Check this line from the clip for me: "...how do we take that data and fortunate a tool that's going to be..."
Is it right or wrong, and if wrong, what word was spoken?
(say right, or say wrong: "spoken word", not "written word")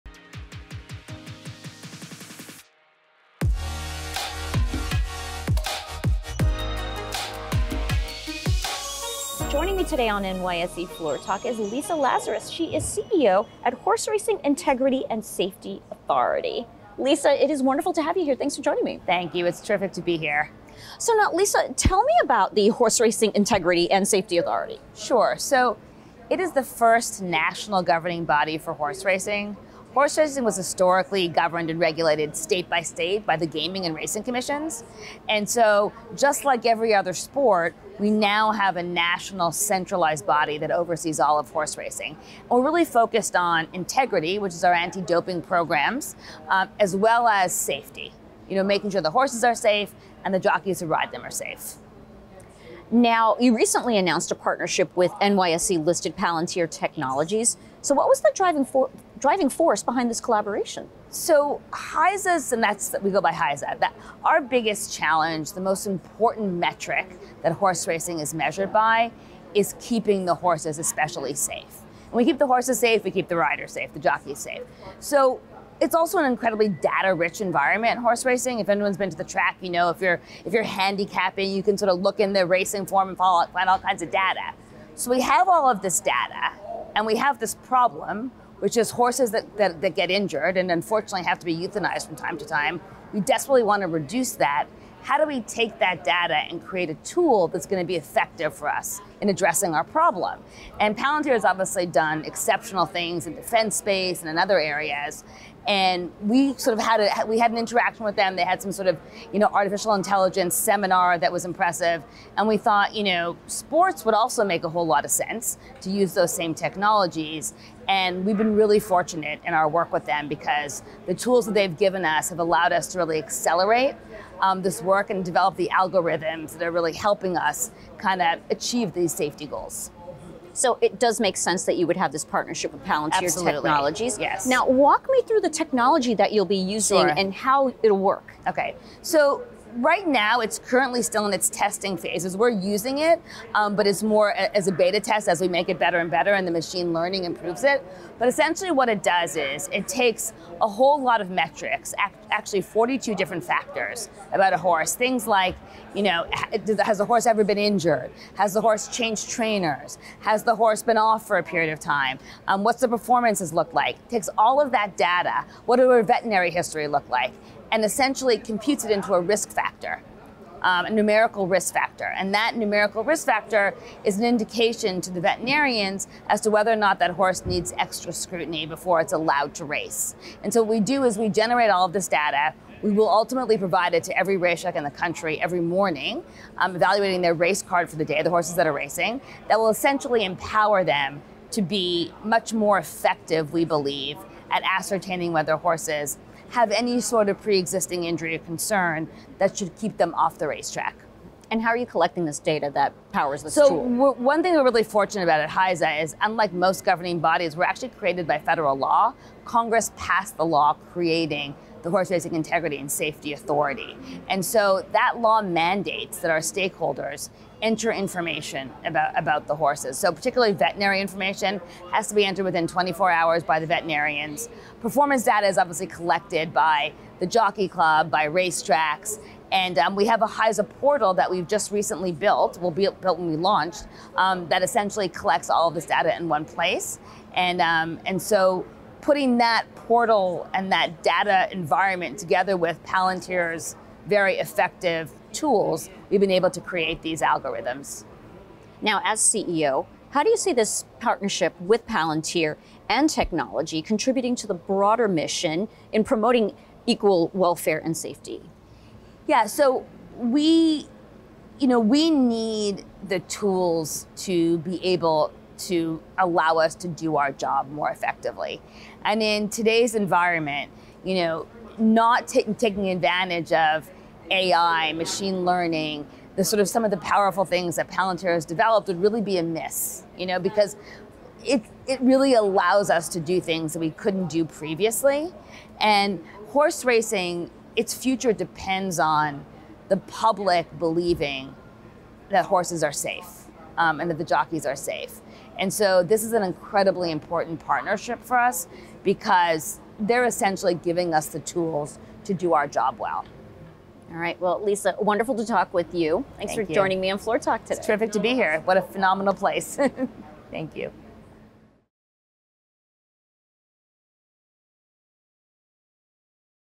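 wrong: "create", not "fortunate".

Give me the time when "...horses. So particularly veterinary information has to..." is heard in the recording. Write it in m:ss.
3:39.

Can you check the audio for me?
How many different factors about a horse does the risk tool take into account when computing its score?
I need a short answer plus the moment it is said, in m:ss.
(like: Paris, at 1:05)
42, at 2:32.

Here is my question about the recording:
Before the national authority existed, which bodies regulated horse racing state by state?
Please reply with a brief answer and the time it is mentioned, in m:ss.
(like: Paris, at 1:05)
gaming and racing commissions, at 0:33.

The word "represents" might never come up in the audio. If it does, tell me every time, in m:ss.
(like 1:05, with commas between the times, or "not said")
not said.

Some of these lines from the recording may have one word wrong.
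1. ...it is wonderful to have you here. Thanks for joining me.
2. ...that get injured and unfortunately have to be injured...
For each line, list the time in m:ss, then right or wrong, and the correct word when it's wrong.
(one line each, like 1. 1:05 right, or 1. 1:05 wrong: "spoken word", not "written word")
1. 0:17 right
2. 1:29 wrong: "euthanized", not "injured".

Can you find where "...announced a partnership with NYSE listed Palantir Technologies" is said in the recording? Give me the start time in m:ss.
0:53.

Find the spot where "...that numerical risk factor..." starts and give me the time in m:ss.
2:52.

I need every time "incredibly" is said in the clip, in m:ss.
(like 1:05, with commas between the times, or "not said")
1:16, 4:56.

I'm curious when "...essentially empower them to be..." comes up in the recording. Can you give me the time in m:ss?
3:09.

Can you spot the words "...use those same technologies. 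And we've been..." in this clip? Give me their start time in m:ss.
1:55.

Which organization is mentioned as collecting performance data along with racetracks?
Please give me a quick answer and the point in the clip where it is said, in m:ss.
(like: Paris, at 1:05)
The Jockey Club, at 3:47.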